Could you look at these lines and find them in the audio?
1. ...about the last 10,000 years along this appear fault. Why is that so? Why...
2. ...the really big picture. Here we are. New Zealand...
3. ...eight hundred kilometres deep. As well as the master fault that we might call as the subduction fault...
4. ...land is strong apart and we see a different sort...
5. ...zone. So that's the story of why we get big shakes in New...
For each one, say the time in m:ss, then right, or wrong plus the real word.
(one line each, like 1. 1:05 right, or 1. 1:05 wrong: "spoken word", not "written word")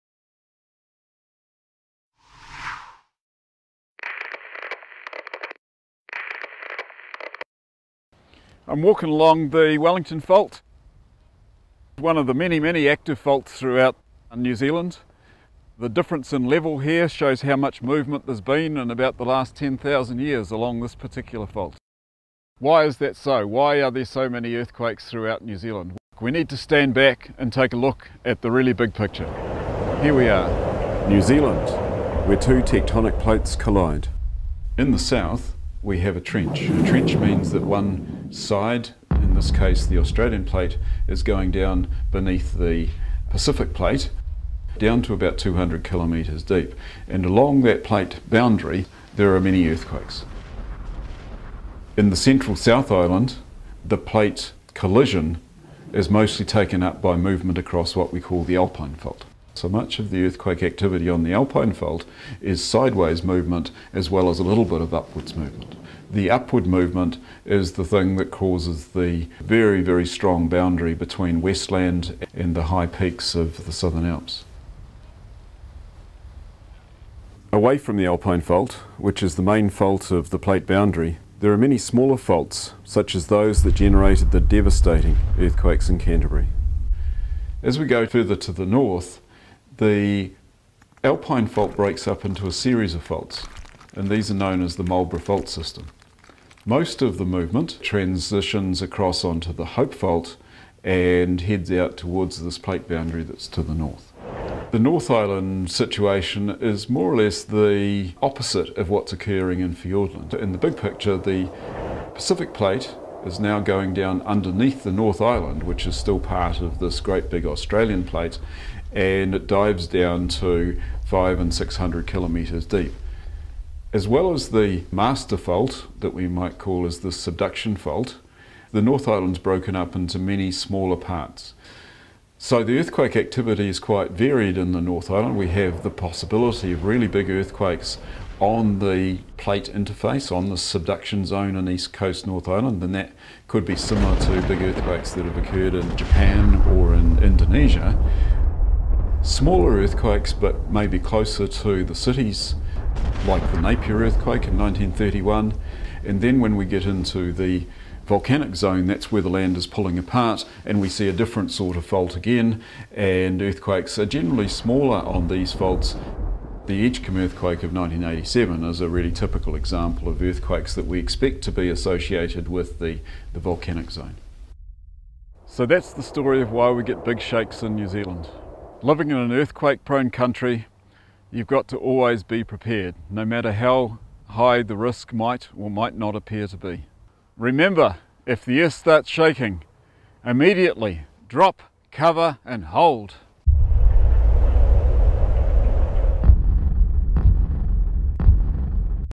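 1. 0:18 wrong: "particular", not "appear"
2. 0:28 right
3. 2:01 wrong: "six", not "eight"
4. 2:39 wrong: "pulling", not "strong"
5. 2:53 right.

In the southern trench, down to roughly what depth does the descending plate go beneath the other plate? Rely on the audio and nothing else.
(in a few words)
200 kilometres.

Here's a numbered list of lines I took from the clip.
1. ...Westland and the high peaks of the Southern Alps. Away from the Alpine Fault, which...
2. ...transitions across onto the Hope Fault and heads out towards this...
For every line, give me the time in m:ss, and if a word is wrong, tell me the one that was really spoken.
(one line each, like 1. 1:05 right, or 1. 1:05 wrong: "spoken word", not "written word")
1. 1:11 right
2. 1:37 right.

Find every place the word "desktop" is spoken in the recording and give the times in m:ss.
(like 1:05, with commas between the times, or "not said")
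not said.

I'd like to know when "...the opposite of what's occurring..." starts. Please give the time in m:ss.
1:47.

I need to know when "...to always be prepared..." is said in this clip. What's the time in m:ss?
3:01.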